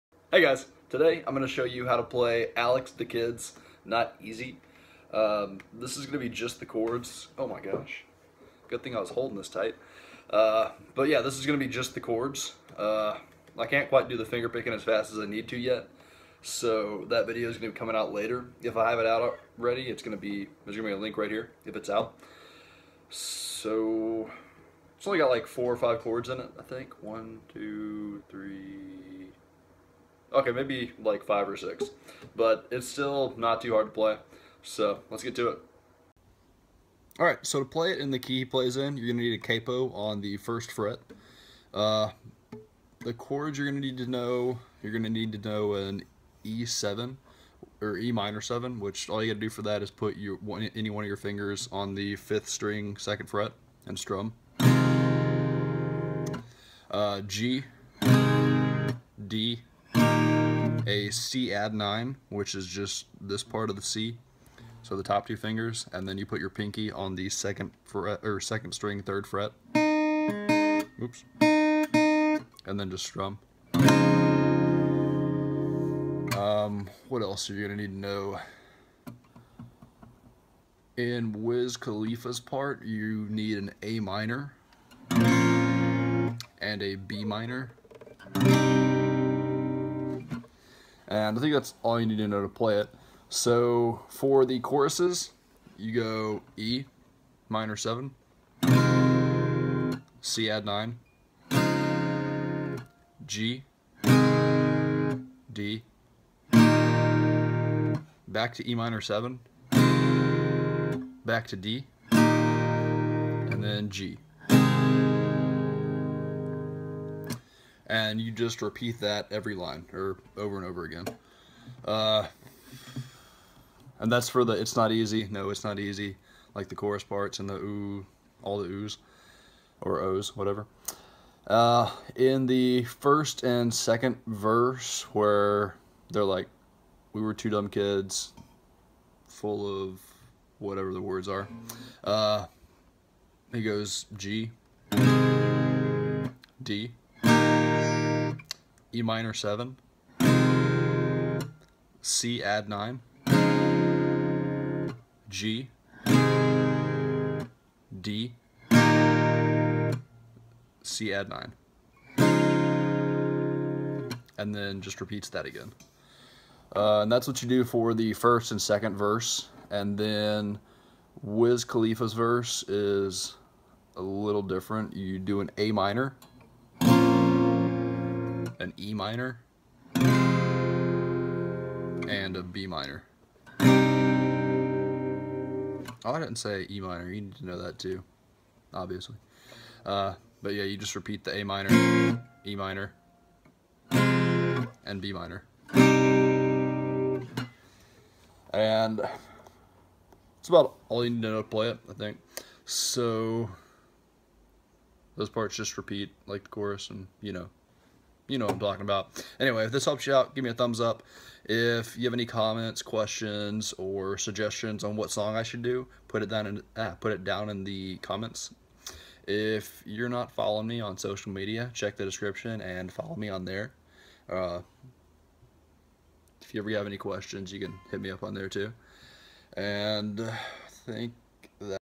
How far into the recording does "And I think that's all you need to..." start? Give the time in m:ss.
1:31.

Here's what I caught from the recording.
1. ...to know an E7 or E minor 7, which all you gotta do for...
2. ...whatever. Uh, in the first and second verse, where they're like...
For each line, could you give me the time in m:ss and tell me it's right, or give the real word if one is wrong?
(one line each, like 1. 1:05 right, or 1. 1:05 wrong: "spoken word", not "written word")
1. 0:45 right
2. 2:10 right.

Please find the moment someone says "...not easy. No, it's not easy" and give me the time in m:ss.
2:04.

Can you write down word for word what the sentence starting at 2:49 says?
And then Wiz Khalifa's verse is a little different.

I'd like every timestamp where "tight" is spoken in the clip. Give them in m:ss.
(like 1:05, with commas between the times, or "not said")
0:09.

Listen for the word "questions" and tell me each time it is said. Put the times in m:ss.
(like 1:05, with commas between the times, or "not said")
3:32, 3:46.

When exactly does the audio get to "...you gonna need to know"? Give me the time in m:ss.
1:17.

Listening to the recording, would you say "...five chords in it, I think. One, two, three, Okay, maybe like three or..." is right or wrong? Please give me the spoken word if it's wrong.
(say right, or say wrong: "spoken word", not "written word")
wrong: "five", not "three".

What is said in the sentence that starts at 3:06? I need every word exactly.
Oh, I didn't say E minor.